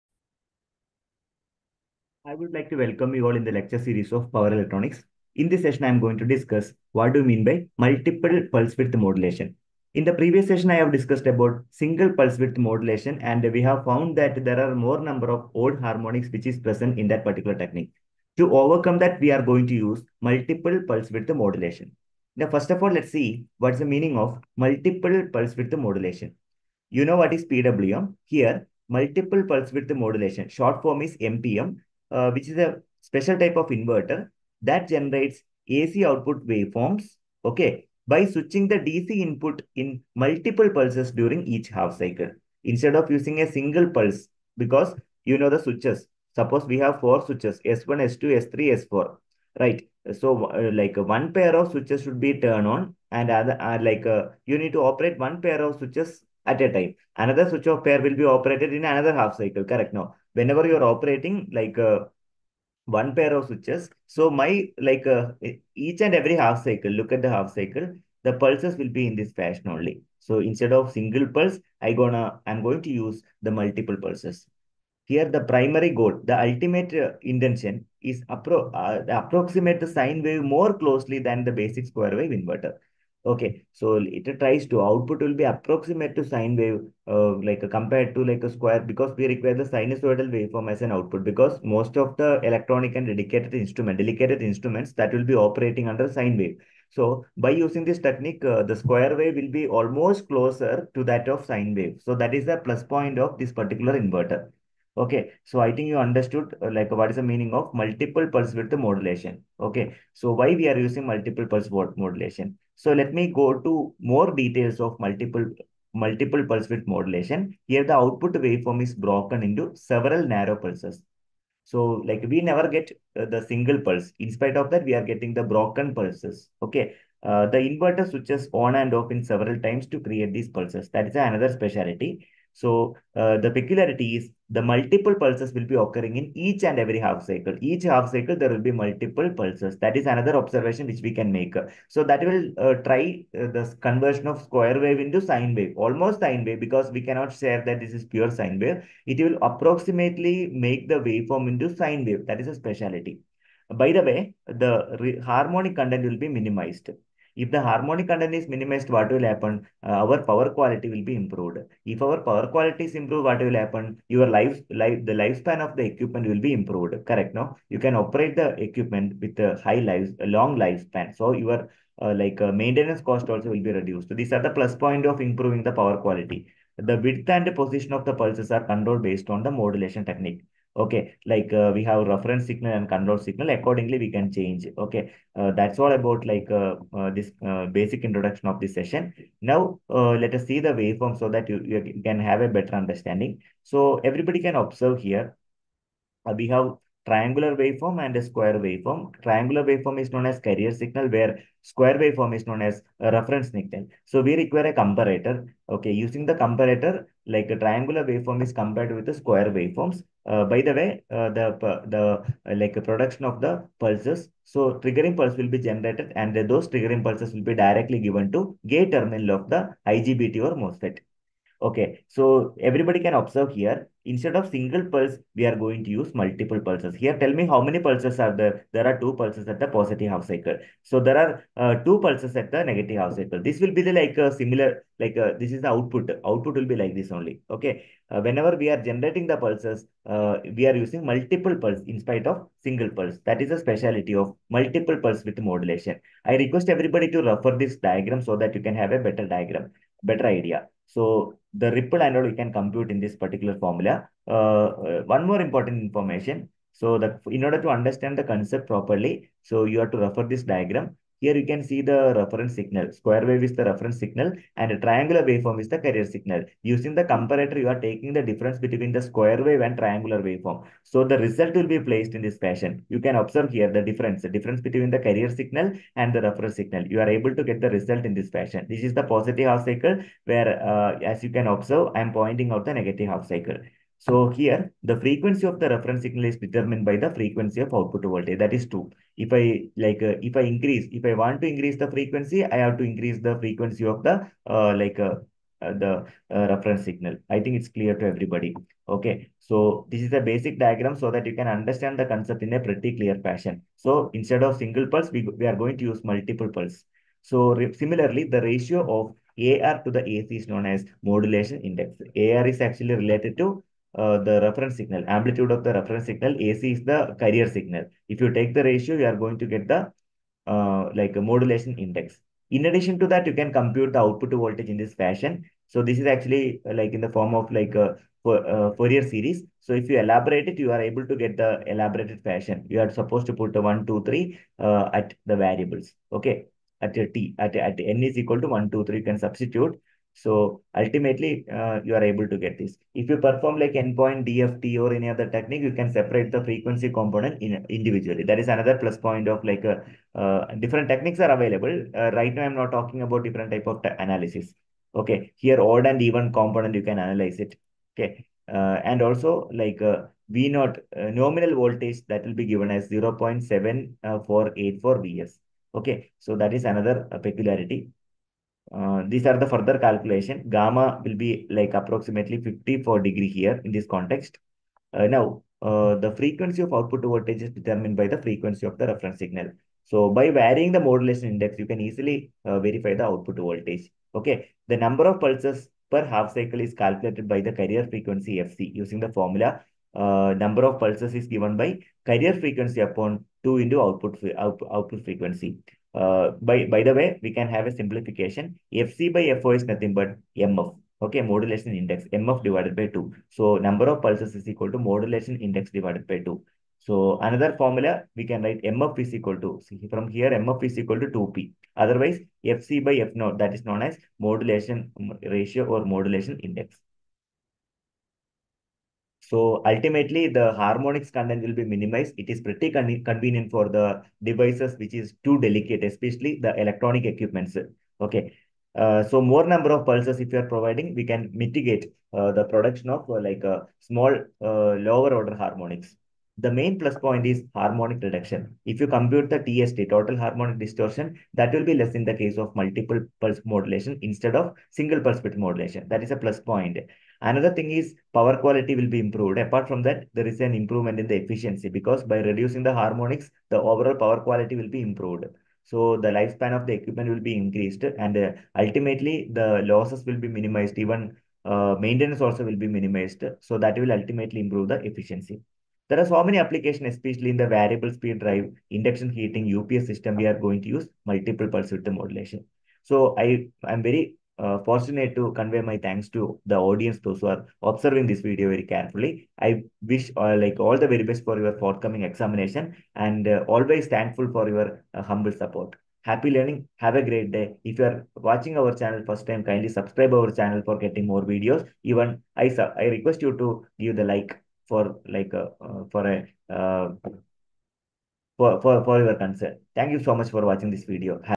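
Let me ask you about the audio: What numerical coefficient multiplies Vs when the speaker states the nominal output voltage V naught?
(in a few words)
0.7484.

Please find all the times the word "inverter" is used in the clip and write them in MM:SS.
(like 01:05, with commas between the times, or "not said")
00:33, 01:22, 01:43, 02:07.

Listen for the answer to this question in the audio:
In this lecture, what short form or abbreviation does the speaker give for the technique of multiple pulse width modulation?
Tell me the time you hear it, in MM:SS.
00:31.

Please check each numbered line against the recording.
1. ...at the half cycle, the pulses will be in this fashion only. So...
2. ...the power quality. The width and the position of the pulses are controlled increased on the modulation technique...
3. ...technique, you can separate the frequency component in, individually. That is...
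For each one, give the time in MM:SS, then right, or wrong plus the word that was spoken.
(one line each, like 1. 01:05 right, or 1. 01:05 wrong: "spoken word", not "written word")
1. 01:07 right
2. 02:55 wrong: "based", not "increased"
3. 05:45 right.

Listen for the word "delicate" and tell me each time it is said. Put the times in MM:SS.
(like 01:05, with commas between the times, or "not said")
07:05.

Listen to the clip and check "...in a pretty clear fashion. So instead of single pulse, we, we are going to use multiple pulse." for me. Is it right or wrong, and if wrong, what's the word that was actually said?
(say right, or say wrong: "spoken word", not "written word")
right.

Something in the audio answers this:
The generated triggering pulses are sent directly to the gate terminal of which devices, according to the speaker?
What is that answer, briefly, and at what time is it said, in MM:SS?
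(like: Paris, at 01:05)
IGBT or MOSFET, at 03:39.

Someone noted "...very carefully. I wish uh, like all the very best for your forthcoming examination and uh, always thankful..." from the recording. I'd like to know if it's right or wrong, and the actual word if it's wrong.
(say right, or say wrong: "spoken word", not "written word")
right.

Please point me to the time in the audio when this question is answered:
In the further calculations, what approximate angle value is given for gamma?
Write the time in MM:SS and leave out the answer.
06:12.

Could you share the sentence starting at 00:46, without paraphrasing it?
Suppose we have four switches, S1, S2, S3, S4, right?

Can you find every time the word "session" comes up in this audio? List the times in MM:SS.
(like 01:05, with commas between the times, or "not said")
00:05, 00:10, 03:08.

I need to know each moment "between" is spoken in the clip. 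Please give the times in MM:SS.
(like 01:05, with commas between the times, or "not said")
04:28, 04:34.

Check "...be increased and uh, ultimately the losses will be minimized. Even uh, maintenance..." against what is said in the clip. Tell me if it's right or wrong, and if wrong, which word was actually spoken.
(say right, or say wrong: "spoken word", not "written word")
right.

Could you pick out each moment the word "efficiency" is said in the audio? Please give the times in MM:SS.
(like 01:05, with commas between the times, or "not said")
07:31, 07:44.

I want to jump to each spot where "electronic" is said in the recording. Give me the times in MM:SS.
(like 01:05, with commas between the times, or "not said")
00:04, 01:32, 07:06.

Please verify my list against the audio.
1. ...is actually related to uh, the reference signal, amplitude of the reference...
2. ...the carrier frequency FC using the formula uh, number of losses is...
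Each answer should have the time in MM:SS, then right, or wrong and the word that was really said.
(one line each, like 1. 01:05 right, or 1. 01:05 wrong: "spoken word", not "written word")
1. 05:12 right
2. 06:27 wrong: "pulses", not "losses".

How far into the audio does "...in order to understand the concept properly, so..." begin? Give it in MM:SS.
04:17.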